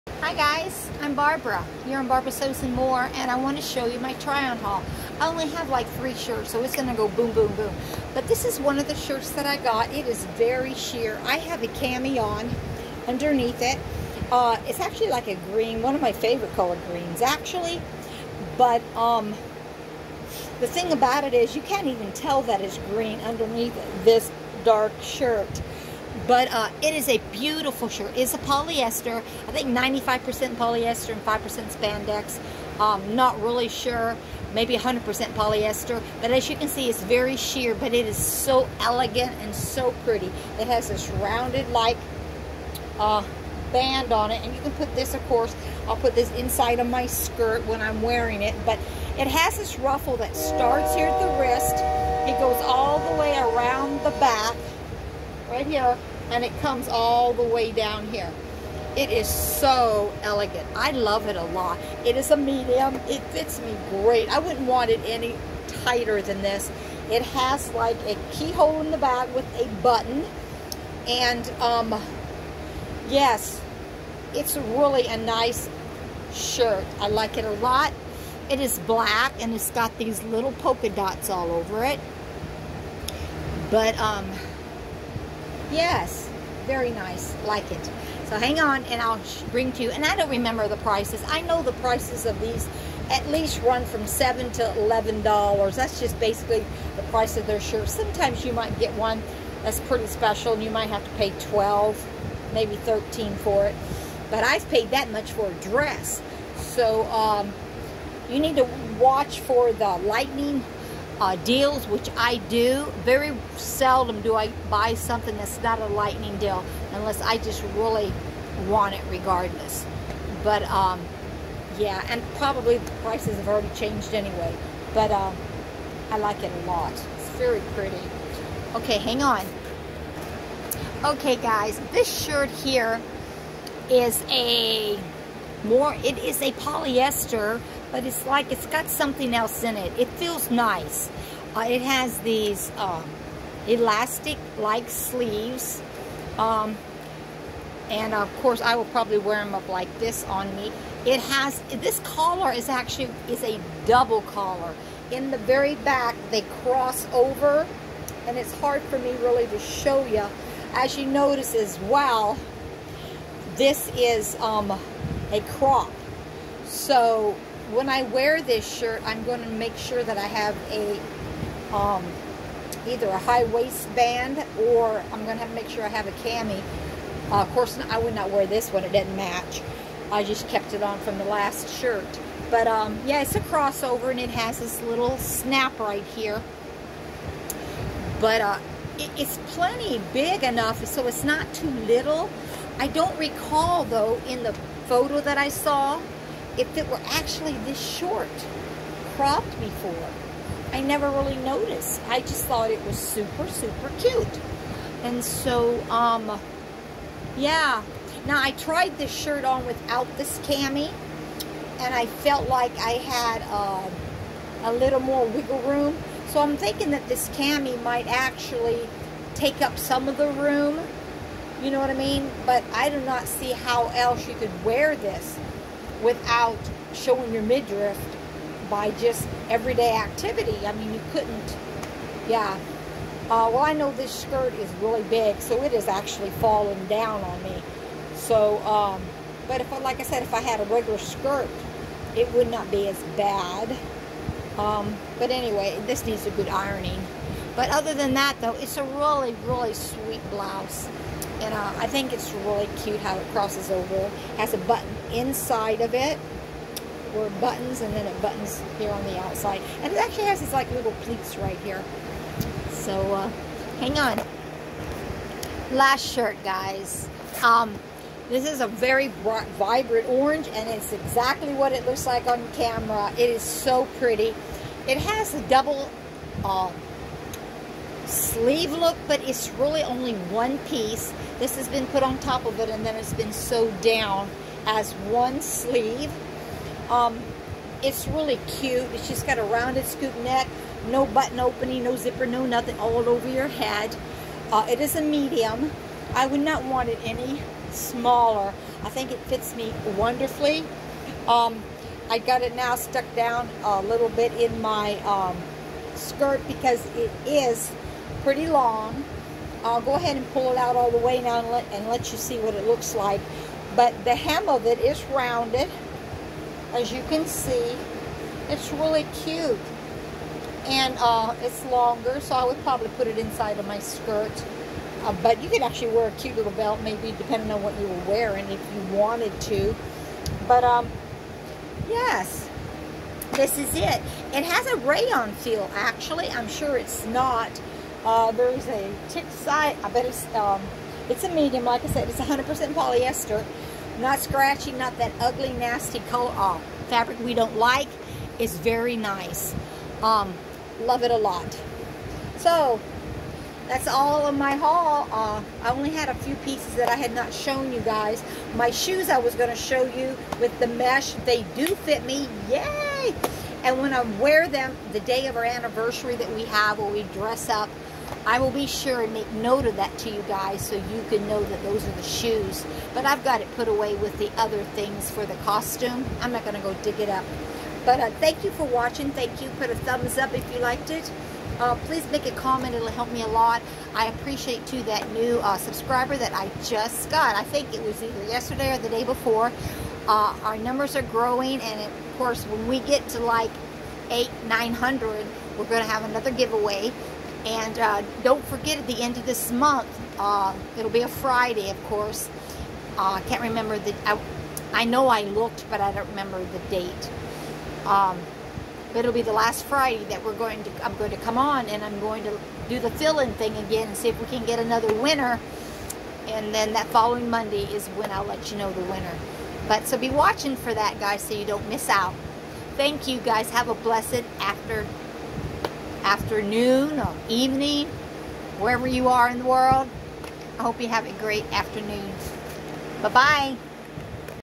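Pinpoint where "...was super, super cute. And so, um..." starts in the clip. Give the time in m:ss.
3:22.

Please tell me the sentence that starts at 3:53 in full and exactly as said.
Uh, well, I know this skirt is really big, so it is actually falling down on me.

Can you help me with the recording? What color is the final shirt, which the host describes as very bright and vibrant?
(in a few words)
Orange.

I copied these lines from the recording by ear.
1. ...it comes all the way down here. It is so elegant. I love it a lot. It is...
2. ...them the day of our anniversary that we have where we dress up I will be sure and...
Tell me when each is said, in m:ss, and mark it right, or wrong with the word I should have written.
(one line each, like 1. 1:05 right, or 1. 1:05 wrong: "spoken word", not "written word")
1. 0:56 right
2. 6:04 right.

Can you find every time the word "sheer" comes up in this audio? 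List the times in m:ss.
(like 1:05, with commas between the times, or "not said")
0:10, 0:37.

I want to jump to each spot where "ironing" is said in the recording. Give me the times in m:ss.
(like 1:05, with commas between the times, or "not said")
4:06.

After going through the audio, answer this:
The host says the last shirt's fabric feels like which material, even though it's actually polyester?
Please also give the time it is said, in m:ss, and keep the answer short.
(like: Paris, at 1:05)
Rayon, at 5:34.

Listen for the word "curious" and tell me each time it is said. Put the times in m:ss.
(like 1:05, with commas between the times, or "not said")
not said.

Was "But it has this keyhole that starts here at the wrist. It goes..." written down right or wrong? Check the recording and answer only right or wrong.
wrong.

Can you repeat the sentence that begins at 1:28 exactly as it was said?
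So hang on and I'll bring to you, and I don't remember the prices.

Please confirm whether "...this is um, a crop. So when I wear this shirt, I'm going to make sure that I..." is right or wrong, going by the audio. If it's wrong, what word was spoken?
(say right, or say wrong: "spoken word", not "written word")
right.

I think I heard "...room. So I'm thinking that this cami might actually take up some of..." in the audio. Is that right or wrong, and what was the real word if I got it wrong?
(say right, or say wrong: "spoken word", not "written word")
right.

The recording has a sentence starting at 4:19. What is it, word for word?
And it actually has these like little pleats right here.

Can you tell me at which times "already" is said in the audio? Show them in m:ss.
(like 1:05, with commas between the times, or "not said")
2:03.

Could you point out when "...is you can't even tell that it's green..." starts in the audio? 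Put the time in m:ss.
0:21.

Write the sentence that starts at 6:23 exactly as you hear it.
I appreciate, too, that new uh, subscriber that I just got.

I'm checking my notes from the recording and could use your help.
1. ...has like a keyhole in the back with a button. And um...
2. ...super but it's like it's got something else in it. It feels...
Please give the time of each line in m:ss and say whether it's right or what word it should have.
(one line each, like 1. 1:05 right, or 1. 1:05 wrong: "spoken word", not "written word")
1. 1:07 right
2. 2:16 wrong: "polyester", not "super".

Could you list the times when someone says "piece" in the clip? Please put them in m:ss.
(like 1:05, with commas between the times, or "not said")
4:40, 5:56.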